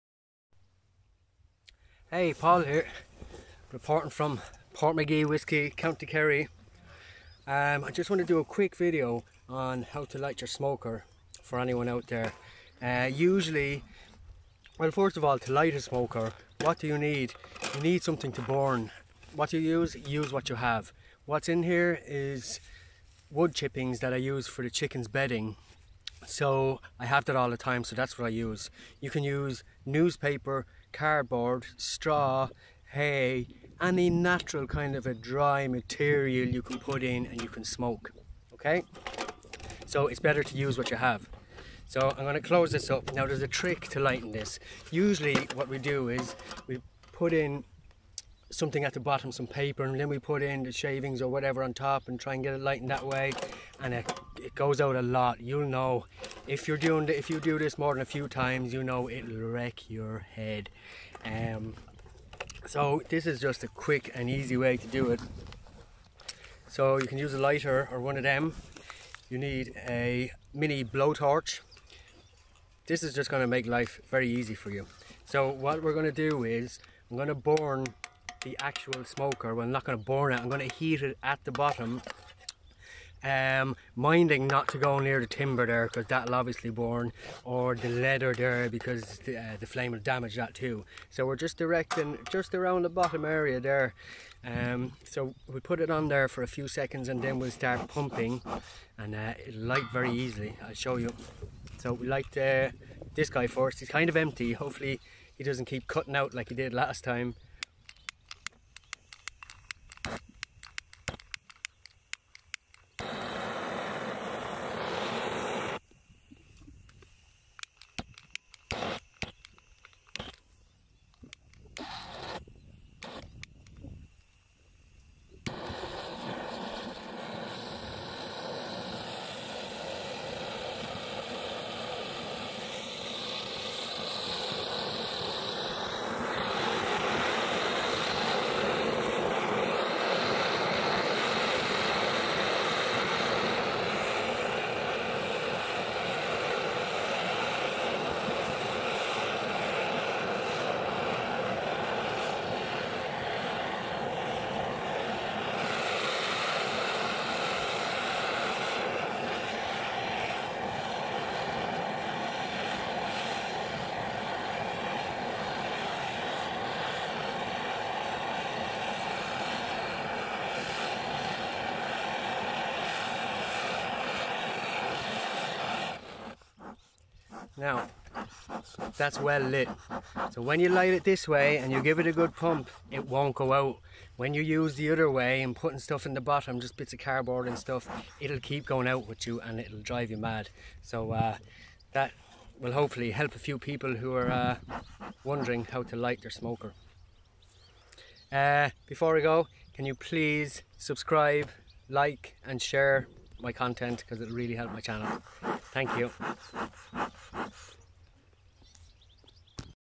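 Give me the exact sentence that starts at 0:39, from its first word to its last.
So it's better to use what you have.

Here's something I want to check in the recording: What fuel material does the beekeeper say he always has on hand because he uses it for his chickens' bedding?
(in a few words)
Wood chippings.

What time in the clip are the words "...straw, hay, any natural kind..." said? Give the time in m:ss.
0:31.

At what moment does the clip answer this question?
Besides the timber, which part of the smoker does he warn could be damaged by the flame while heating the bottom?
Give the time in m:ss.
1:27.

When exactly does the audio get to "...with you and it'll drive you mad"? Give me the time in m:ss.
3:09.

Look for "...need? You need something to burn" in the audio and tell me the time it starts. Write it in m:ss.
0:16.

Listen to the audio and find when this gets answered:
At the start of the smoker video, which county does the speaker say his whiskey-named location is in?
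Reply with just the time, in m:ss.
0:05.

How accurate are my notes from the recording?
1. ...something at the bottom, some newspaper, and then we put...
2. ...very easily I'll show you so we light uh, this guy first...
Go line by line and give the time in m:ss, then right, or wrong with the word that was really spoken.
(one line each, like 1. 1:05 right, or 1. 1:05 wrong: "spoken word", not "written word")
1. 0:48 wrong: "paper", not "newspaper"
2. 1:39 right.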